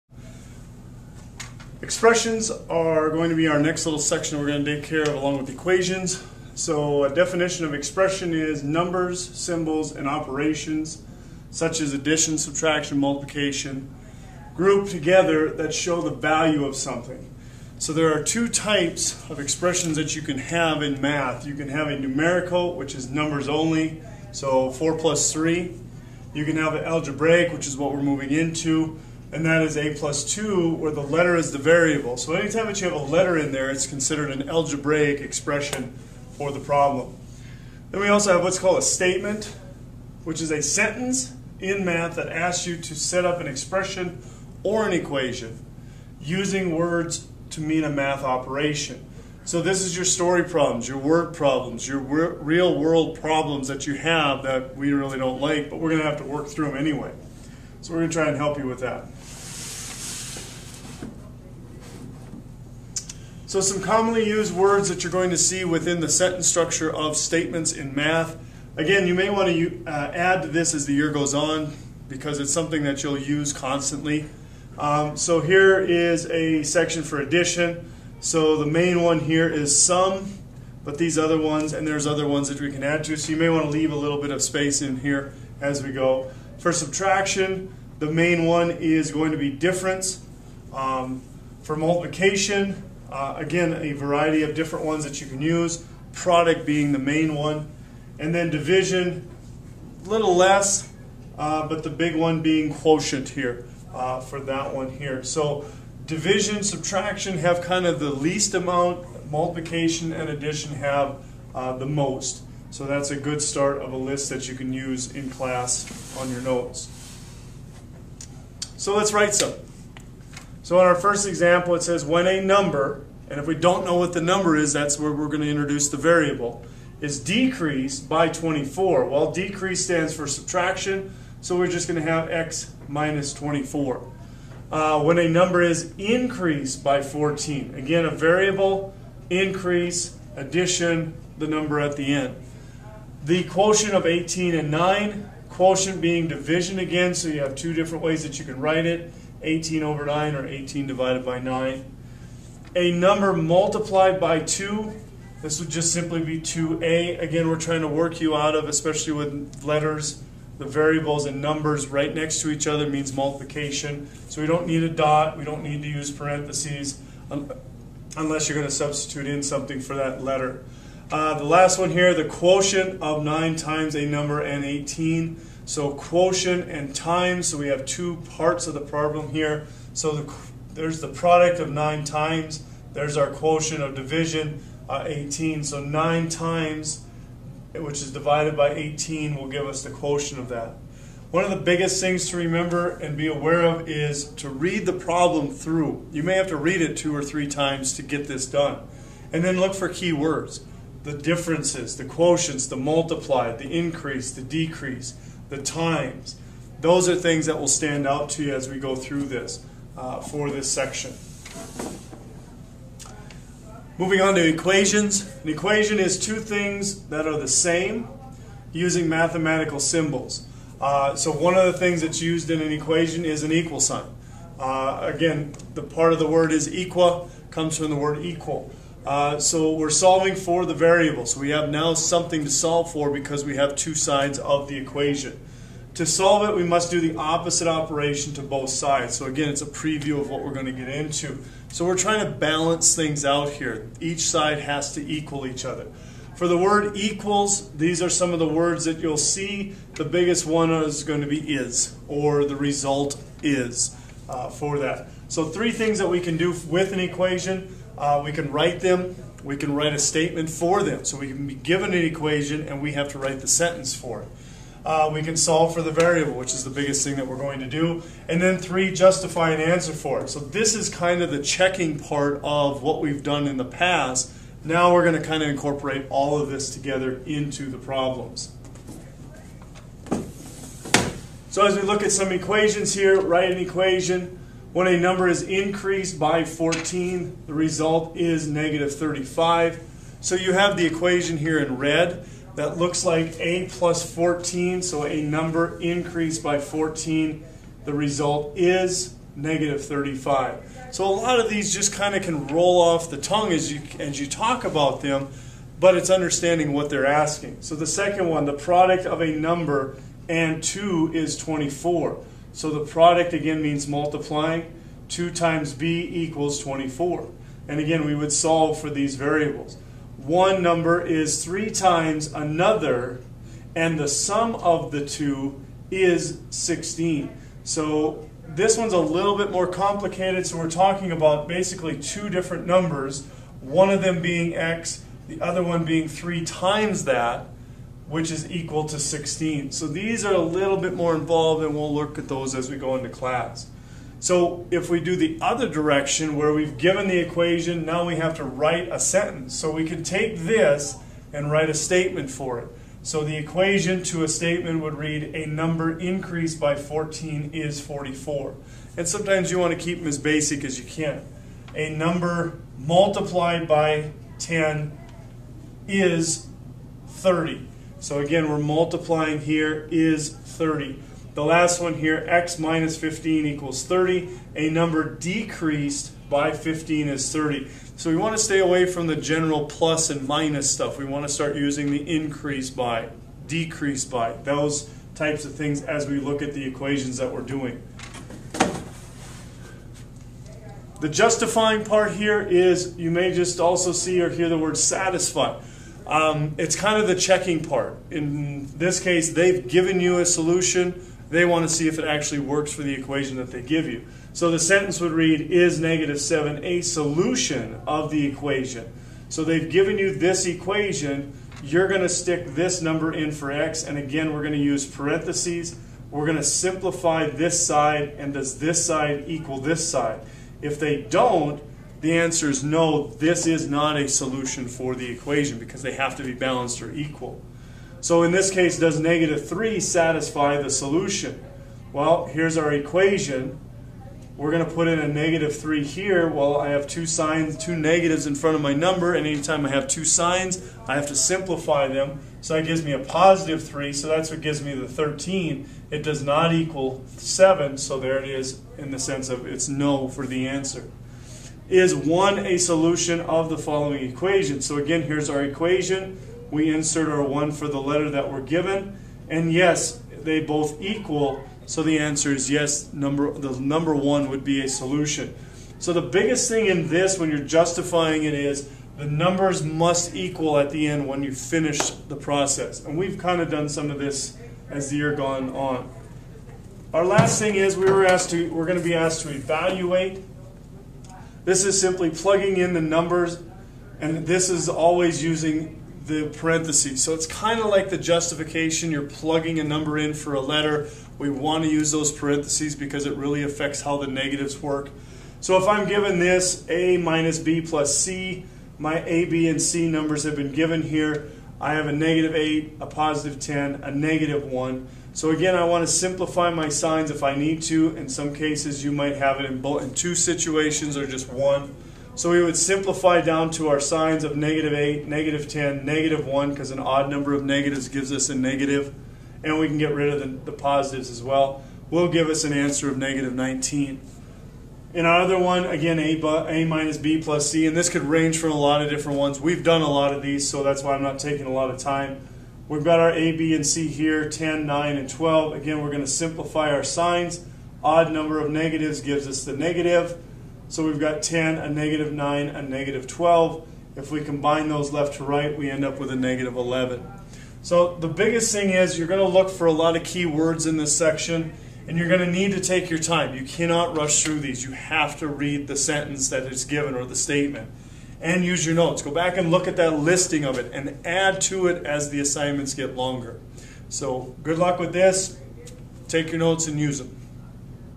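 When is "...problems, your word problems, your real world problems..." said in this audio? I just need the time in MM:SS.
00:50.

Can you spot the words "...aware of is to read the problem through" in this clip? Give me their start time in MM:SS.
03:13.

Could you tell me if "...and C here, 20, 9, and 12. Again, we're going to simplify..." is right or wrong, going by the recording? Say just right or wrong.
wrong.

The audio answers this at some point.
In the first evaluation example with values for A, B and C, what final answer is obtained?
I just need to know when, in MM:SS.
08:42.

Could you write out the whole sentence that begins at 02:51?
Uh, the last one here, the quotient of 9 times a number and 18.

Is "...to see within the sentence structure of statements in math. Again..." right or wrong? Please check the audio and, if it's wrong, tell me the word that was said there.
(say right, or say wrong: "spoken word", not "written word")
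right.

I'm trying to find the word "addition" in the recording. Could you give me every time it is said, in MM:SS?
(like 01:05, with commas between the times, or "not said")
00:11, 01:17, 01:50, 02:20.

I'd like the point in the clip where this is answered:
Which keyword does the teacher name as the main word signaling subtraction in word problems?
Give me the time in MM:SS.
01:29.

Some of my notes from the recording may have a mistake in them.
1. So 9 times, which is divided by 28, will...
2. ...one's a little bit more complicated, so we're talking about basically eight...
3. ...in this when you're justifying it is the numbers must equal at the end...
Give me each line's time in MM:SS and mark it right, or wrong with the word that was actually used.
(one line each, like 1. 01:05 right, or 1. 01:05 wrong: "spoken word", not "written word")
1. 03:05 wrong: "18", not "28"
2. 05:28 wrong: "two", not "eight"
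3. 07:46 right.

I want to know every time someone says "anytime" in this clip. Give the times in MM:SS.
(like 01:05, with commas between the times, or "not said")
00:32, 07:19.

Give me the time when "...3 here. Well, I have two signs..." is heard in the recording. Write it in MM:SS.
07:15.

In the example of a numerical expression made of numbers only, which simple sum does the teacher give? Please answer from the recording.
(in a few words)
4 + 3.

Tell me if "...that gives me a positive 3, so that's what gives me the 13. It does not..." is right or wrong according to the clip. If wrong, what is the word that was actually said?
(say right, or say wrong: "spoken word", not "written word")
right.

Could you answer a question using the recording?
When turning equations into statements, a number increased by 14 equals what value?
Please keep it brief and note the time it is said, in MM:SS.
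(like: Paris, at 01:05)
44, at 05:57.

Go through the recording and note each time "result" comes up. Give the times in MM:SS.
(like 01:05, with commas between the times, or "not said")
04:12, 04:47, 04:57.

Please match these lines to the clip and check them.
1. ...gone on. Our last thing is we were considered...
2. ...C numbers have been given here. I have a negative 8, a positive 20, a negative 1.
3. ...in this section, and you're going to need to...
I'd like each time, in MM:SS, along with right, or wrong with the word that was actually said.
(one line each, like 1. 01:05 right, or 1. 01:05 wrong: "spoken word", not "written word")
1. 07:55 wrong: "asked", not "considered"
2. 08:19 wrong: "10", not "20"
3. 09:10 right.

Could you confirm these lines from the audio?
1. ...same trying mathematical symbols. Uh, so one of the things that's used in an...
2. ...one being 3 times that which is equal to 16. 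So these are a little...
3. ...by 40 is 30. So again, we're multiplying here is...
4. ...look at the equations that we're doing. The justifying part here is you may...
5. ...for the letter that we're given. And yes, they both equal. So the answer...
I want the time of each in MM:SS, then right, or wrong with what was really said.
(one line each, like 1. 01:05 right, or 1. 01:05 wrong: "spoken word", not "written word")
1. 03:37 wrong: "using", not "trying"
2. 05:35 right
3. 06:03 wrong: "10", not "40"
4. 06:26 right
5. 07:37 right.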